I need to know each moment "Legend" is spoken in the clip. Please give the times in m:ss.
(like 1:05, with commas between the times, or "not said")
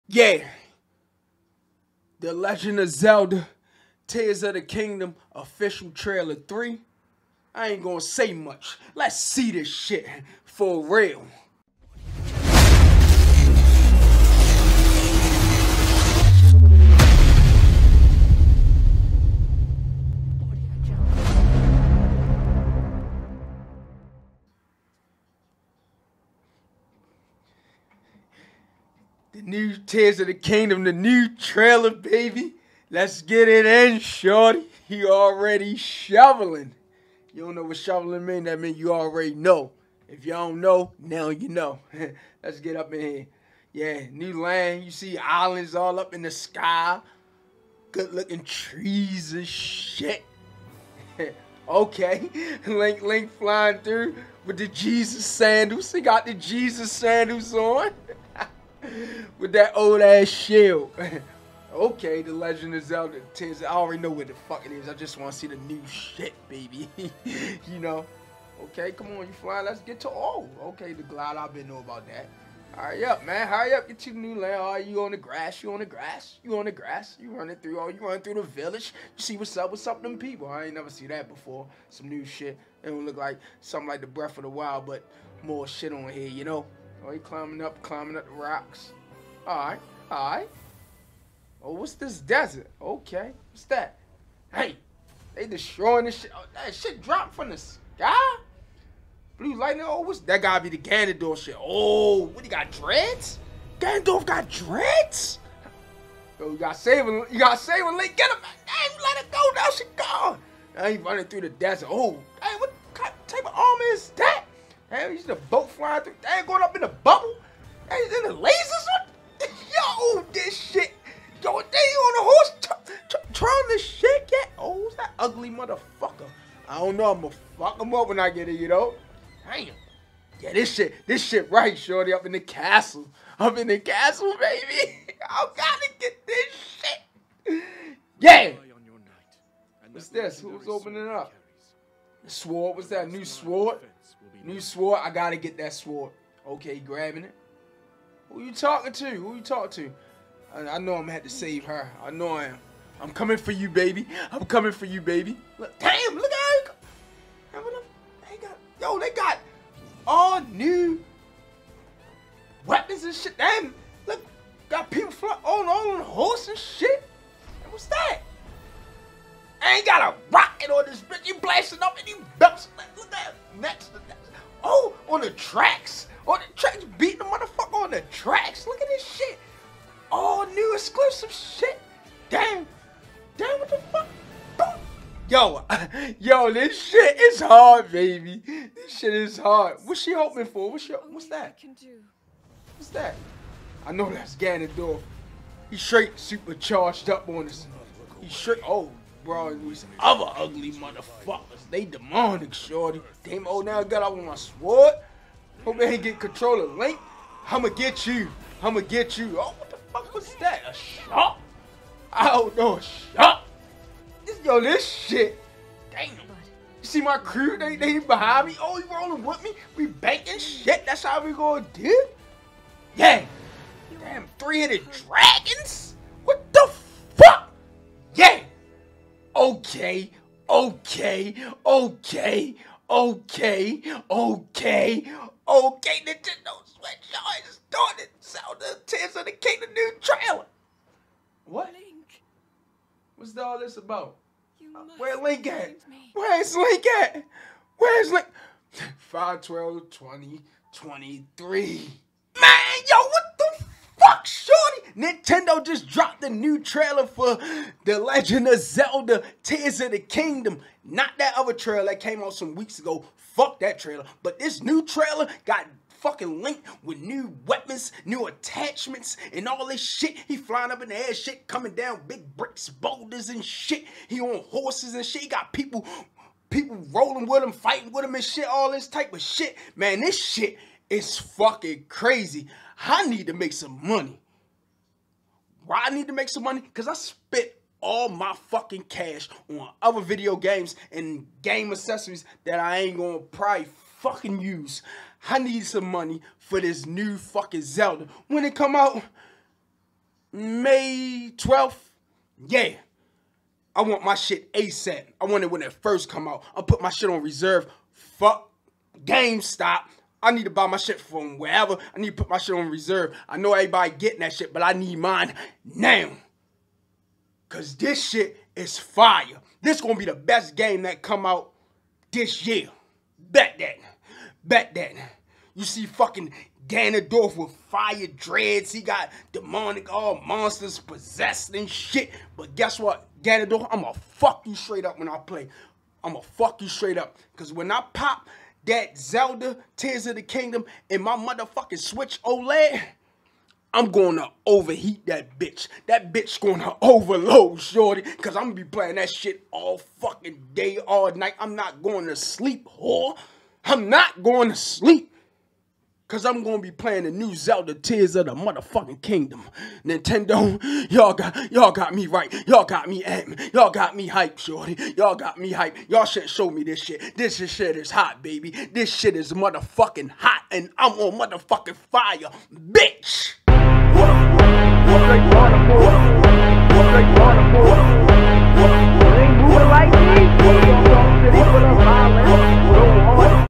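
0:02, 1:02, 4:17.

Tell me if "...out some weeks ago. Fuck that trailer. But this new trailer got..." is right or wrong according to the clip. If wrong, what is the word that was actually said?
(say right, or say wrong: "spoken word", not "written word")
right.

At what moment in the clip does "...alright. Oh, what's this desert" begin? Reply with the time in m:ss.
1:30.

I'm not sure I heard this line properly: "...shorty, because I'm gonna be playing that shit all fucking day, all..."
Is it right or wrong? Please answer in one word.
right.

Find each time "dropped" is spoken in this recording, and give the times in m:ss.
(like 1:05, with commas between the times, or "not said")
1:37, 4:15.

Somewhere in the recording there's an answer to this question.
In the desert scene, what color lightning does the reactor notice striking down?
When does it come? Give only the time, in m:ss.
1:39.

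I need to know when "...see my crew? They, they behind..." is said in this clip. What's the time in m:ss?
3:36.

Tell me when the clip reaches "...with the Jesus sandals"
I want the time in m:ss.
0:54.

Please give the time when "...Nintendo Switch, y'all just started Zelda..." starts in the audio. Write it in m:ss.
3:56.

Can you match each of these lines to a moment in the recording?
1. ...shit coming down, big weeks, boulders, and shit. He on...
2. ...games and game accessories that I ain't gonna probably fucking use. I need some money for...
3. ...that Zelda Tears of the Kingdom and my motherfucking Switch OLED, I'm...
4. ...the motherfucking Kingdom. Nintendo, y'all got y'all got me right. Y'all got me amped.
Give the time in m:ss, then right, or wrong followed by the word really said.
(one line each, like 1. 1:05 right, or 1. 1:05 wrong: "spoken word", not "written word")
1. 4:31 wrong: "bricks", not "weeks"
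2. 4:50 right
3. 5:38 right
4. 5:58 right.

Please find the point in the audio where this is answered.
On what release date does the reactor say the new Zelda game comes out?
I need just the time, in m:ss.
5:00.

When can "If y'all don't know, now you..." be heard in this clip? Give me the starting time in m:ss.
0:40.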